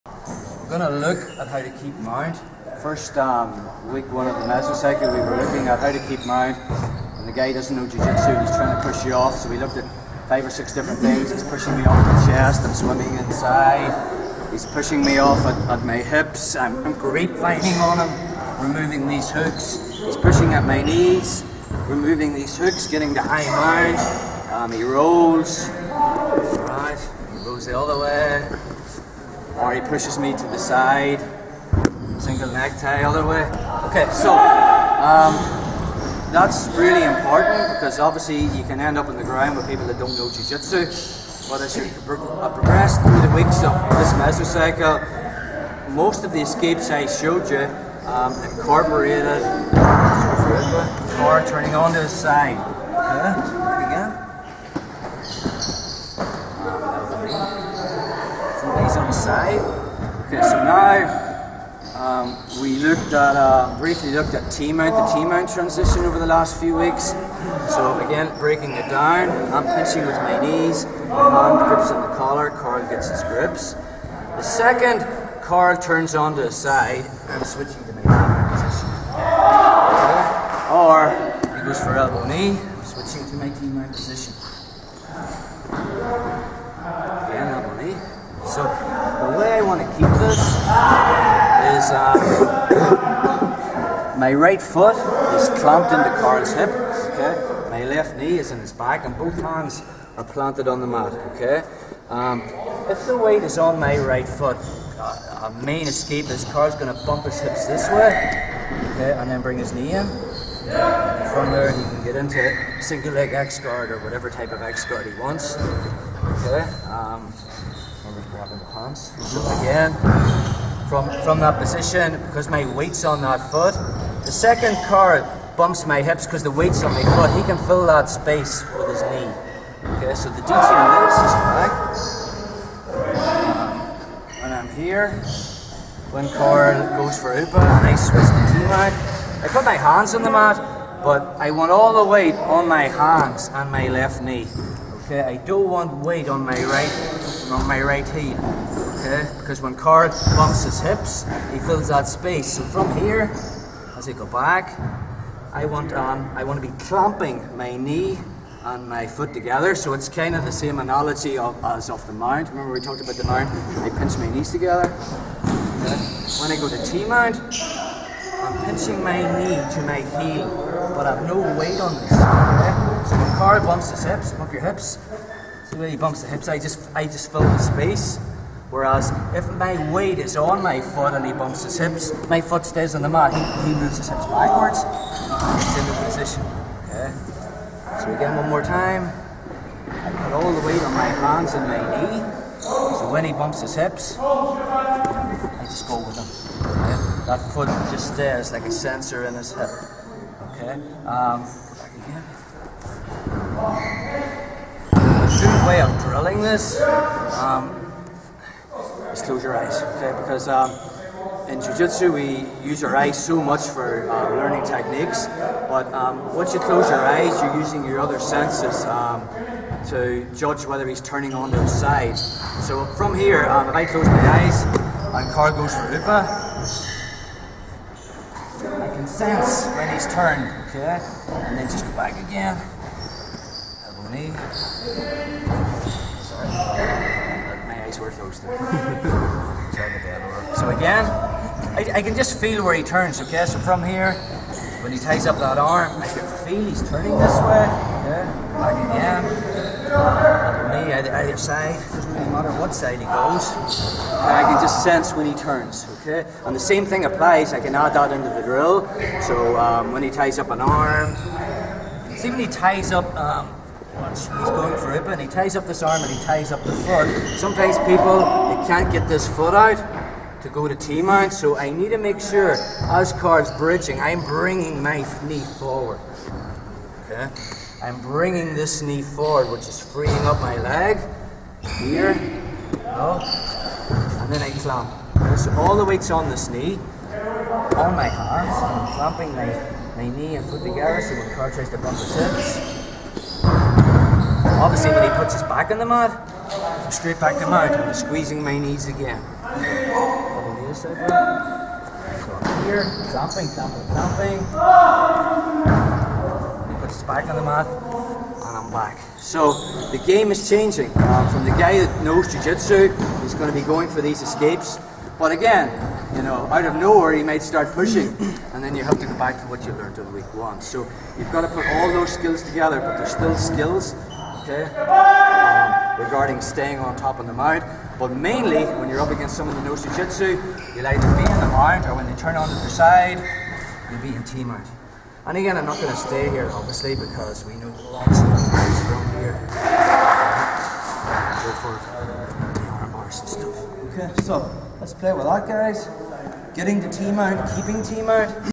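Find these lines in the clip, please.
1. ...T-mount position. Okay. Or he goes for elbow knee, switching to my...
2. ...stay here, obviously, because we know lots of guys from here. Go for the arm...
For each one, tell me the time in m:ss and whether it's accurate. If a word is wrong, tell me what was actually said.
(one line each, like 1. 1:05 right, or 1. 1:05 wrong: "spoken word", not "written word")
1. 1:18 right
2. 5:35 right.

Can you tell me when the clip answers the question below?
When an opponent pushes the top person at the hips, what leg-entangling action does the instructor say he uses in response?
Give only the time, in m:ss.
0:16.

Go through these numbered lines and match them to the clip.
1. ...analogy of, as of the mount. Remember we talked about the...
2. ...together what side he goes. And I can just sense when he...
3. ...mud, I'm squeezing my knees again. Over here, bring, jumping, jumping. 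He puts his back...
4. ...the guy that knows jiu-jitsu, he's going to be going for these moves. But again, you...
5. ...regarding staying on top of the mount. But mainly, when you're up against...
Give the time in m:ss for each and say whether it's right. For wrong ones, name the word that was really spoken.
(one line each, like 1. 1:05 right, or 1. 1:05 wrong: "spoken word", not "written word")
1. 2:40 right
2. 4:12 wrong: "matter", not "together"
3. 4:57 wrong: "jumping", not "bring"
4. 5:11 wrong: "escapes", not "moves"
5. 5:26 right.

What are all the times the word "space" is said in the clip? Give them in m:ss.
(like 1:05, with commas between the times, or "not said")
2:08, 2:32, 2:57.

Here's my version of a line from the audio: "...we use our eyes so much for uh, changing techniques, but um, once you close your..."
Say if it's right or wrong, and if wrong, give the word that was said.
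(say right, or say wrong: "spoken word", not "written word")
wrong: "learning", not "changing".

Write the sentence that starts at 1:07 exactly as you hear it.
So again, breaking it down, I'm pinching with my knees, my hand grips on the collar, Carl gets his grips.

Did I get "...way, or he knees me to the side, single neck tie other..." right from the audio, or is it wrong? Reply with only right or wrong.
wrong.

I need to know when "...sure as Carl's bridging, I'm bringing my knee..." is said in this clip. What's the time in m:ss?
4:32.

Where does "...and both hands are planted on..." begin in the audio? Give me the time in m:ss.
1:39.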